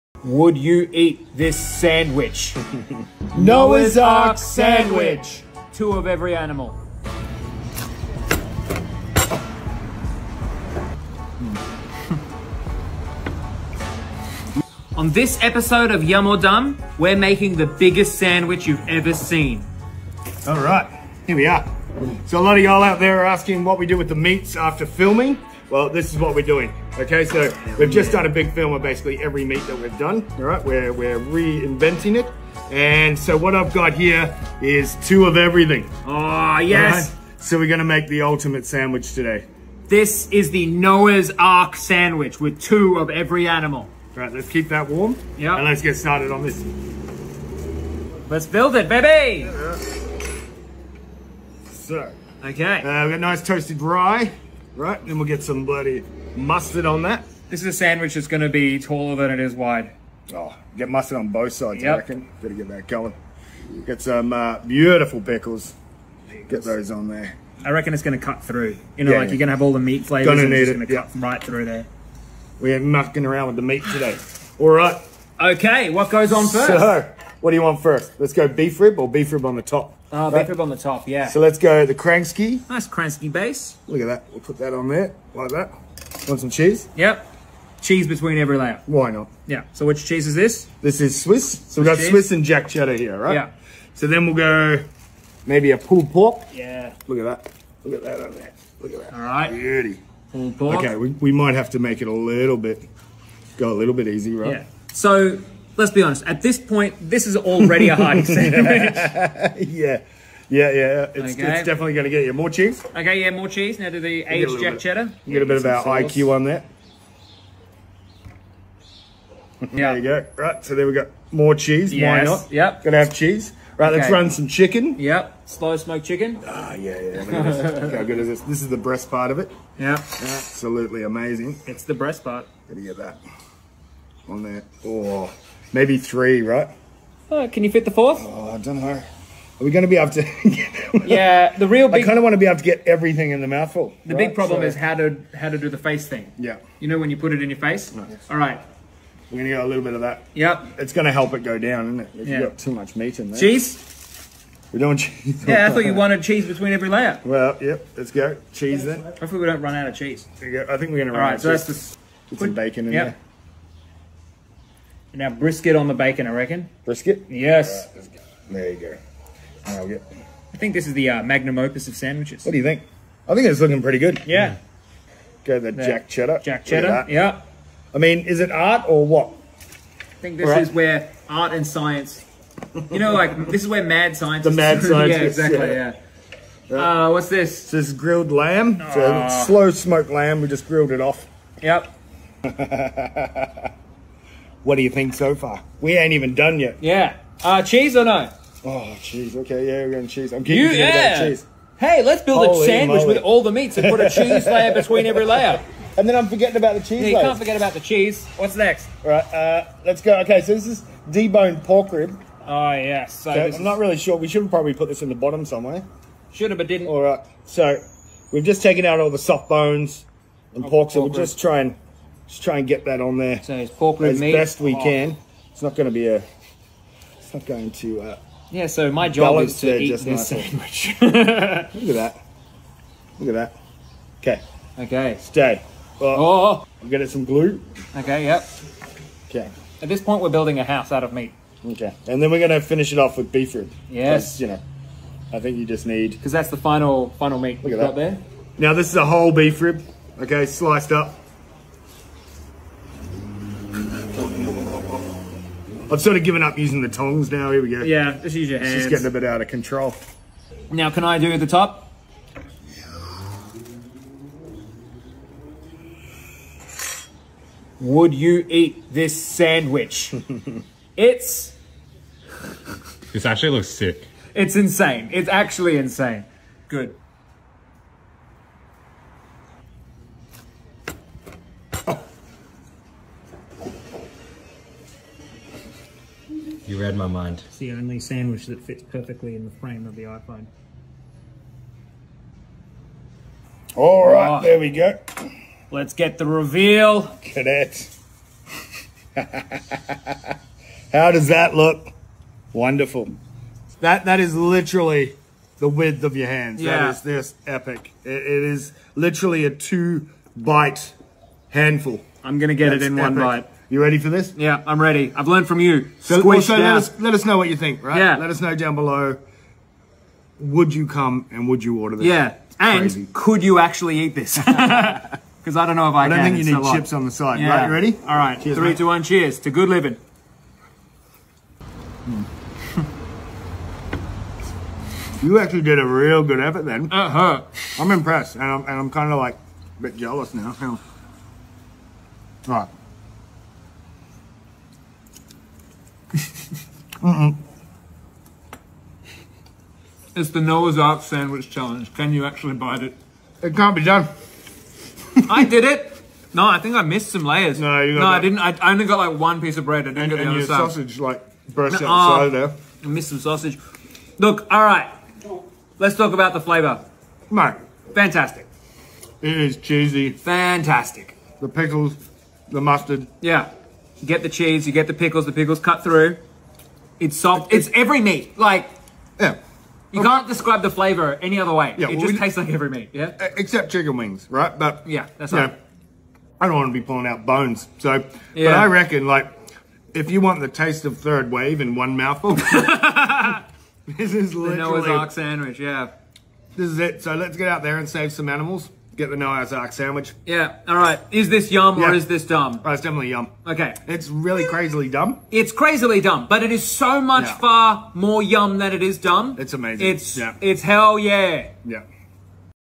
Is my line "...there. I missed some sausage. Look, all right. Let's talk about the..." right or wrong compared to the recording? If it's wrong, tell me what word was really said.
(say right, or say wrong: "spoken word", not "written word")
right.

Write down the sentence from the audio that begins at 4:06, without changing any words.
Because that's the final final meat Look at that.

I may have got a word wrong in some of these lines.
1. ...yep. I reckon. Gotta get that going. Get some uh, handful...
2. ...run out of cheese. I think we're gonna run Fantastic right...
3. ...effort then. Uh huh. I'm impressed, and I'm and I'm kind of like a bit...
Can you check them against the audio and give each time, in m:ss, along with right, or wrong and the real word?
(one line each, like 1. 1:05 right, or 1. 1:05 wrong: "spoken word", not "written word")
1. 1:01 wrong: "beautiful", not "handful"
2. 2:39 wrong: "All", not "Fantastic"
3. 5:36 right.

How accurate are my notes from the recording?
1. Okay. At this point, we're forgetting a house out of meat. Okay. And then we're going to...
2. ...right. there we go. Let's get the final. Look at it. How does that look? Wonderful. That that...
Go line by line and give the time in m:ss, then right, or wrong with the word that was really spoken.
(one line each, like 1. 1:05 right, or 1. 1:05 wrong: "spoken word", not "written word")
1. 3:59 wrong: "building", not "forgetting"
2. 4:54 wrong: "reveal", not "final".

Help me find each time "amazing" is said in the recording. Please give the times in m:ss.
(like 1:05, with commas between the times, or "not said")
2:11, 6:49.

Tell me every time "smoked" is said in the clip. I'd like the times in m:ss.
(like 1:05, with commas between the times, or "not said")
2:05, 3:09.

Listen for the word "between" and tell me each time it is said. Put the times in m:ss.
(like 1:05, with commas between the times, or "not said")
1:28, 2:36, 3:24.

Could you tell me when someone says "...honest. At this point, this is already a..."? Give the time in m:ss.
1:46.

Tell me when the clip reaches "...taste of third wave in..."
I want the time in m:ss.
6:30.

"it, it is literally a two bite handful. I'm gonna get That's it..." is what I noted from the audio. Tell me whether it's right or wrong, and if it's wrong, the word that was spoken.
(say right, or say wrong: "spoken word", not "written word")
right.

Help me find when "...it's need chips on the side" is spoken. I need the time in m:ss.
5:26.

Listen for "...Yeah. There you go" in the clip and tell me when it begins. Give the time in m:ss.
1:59.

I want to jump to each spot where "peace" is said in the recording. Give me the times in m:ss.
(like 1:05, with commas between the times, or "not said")
not said.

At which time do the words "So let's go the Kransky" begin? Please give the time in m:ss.
1:21.